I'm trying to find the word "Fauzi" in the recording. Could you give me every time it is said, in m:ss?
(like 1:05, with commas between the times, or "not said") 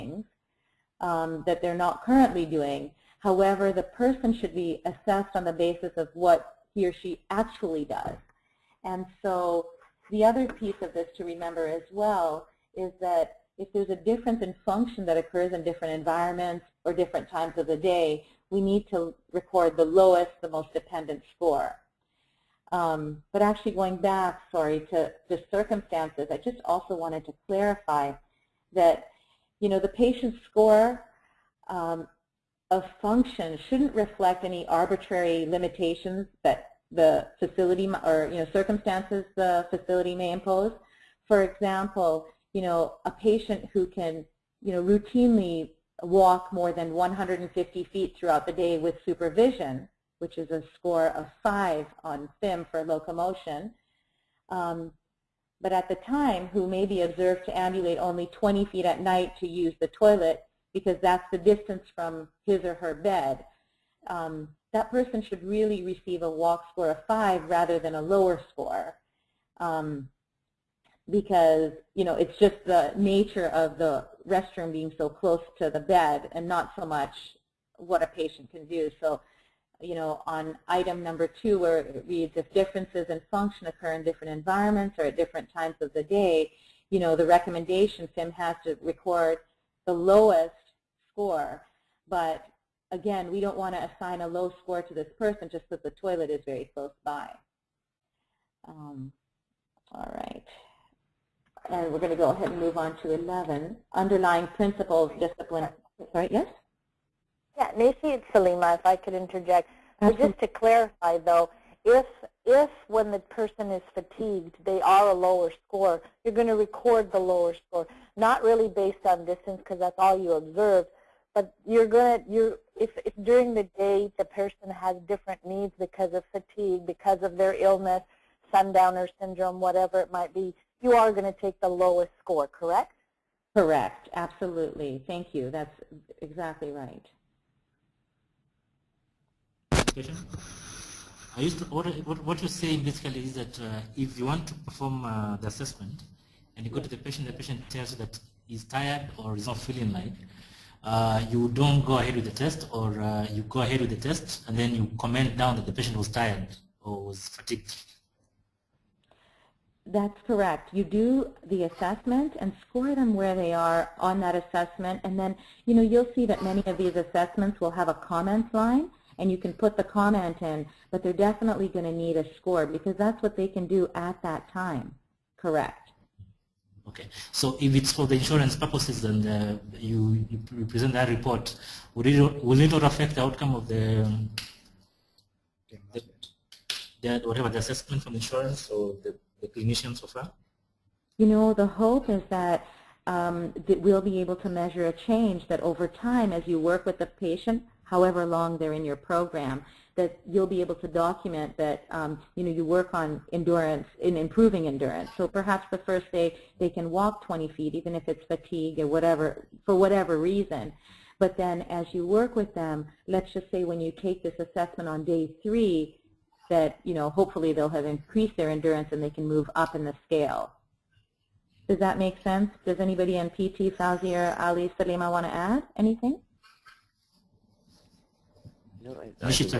3:43.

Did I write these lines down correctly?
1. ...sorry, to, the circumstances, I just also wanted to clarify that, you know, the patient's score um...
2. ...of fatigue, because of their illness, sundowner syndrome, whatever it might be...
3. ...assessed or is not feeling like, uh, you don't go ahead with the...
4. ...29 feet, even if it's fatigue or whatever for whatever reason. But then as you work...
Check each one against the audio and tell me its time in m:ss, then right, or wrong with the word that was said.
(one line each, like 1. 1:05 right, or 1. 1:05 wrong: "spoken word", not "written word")
1. 0:24 right
2. 2:06 right
3. 2:28 wrong: "tired", not "assessed"
4. 3:27 wrong: "20", not "29".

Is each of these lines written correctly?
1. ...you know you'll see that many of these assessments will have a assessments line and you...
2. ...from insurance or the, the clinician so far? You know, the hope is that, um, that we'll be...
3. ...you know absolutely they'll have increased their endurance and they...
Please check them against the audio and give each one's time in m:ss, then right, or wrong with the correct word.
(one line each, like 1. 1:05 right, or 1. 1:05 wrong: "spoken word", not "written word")
1. 2:45 wrong: "comments", not "assessments"
2. 3:08 right
3. 3:36 wrong: "hopefully", not "absolutely".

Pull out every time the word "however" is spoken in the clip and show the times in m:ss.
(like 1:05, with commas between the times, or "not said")
0:03, 3:17.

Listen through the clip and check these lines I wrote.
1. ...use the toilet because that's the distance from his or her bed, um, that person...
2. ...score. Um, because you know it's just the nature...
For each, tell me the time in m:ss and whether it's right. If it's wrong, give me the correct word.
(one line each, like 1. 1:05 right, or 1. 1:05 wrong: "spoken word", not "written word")
1. 0:59 right
2. 1:08 right.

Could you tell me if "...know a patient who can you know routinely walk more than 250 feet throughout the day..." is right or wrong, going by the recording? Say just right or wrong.
wrong.